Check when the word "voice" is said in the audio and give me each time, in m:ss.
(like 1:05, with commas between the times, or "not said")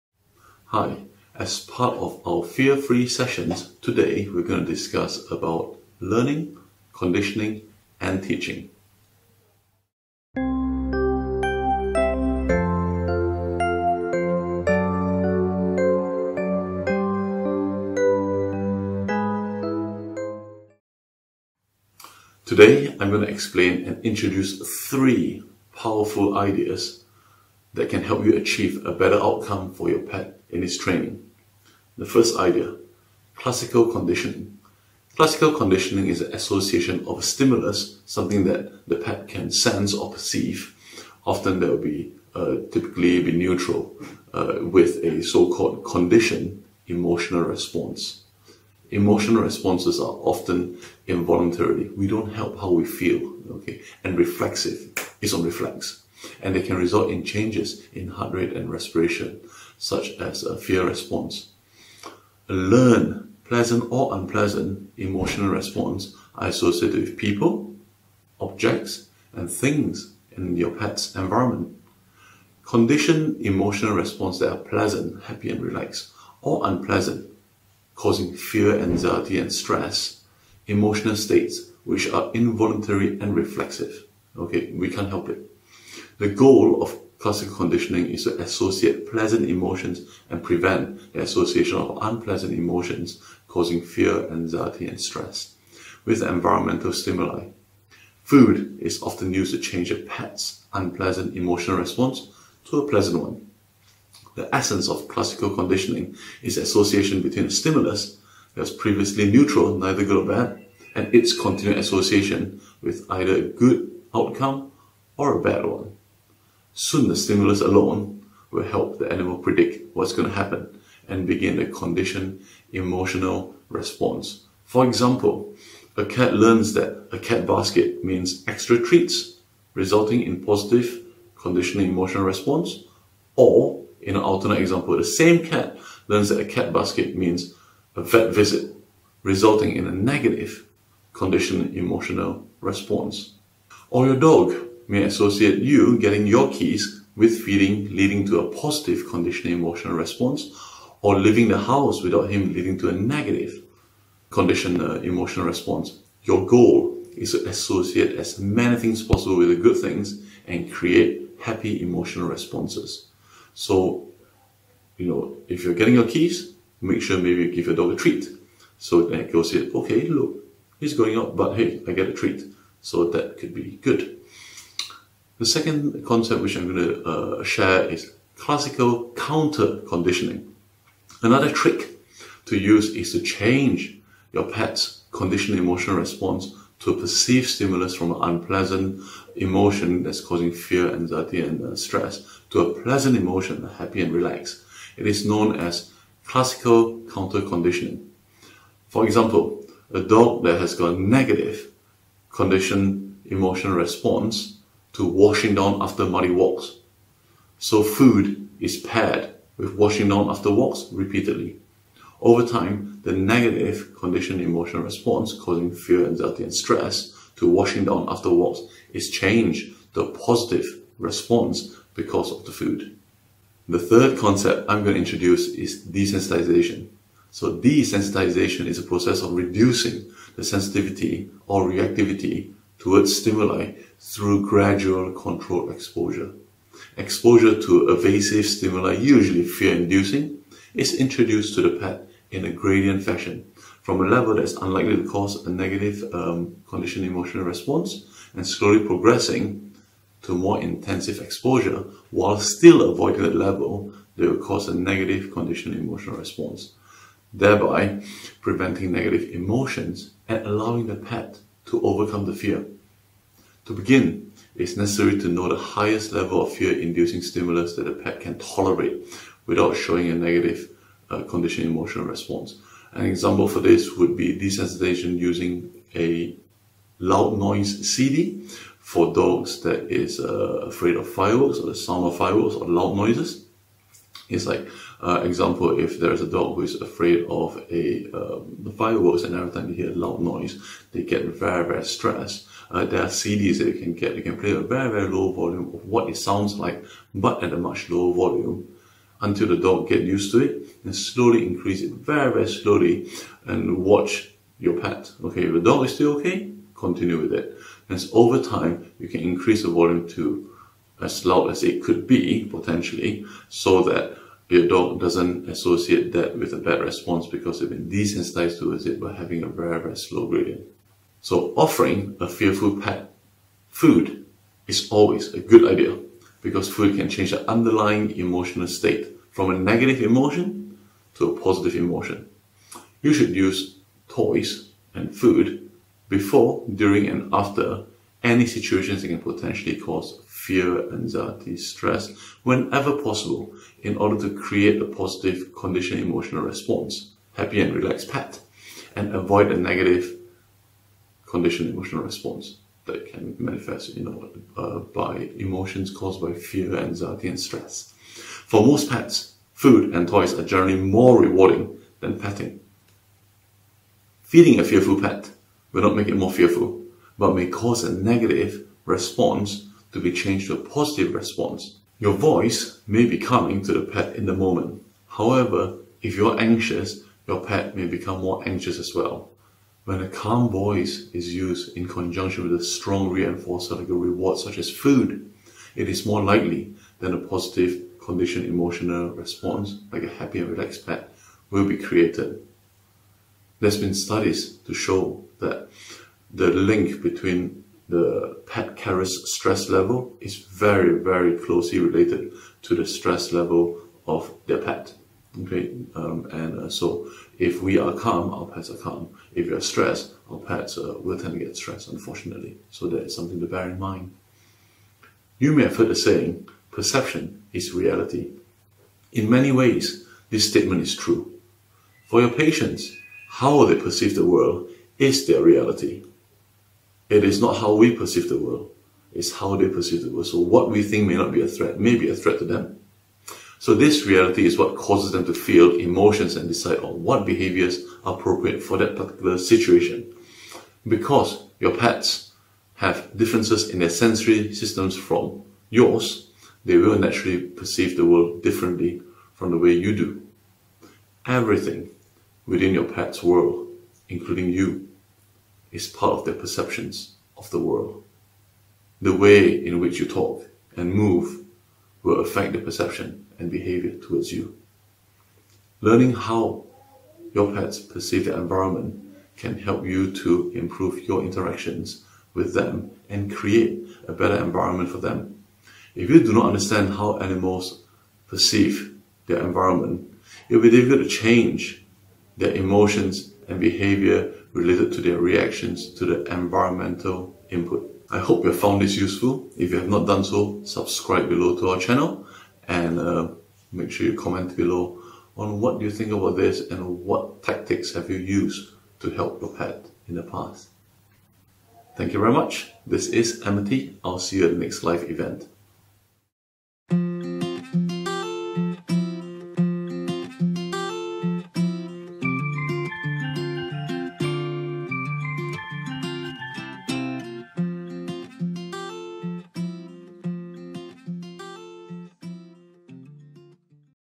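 6:12, 6:20.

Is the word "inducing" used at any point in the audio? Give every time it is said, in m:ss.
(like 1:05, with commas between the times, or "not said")
3:59, 4:26.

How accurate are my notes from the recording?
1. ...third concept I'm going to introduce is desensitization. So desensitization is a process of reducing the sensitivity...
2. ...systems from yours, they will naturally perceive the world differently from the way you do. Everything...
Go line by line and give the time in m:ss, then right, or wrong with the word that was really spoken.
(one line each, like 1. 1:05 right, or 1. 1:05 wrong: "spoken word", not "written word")
1. 3:43 right
2. 7:24 right.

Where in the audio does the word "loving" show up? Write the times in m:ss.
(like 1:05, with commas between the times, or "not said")
not said.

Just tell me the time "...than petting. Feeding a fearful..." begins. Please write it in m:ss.
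6:02.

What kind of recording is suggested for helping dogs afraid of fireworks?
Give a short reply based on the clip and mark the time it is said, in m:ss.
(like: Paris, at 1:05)
Loud noise CD, at 4:36.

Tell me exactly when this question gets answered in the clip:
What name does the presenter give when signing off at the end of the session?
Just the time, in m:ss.
8:23.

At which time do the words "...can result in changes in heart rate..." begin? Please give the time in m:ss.
0:56.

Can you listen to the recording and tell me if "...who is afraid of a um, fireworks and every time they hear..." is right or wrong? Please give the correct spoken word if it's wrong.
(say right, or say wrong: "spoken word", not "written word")
right.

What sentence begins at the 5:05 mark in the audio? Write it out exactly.
Okay, if the dog is still okay, continue with it.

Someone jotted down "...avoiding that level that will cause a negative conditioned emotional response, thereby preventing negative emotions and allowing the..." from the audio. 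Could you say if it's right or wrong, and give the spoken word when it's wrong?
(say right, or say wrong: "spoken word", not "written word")
right.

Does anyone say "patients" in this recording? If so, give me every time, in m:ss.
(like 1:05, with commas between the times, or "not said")
7:02.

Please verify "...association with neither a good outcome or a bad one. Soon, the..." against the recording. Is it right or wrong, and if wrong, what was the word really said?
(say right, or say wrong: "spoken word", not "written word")
wrong: "either", not "neither".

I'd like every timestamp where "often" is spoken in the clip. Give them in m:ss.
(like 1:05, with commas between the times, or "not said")
0:41, 0:50, 1:39.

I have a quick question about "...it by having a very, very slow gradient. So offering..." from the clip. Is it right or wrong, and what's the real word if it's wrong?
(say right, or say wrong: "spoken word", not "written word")
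right.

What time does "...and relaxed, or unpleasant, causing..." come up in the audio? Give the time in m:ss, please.
1:15.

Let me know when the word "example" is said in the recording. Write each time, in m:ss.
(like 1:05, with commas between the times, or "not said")
2:04, 2:14, 3:19, 4:33, 4:45.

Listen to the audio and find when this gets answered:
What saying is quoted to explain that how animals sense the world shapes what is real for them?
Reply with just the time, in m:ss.
6:56.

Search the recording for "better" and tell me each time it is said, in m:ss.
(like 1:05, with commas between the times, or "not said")
0:28, 7:54.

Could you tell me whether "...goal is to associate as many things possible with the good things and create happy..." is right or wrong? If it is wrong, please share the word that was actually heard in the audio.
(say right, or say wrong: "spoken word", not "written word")
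right.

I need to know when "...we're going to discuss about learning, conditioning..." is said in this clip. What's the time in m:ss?
0:04.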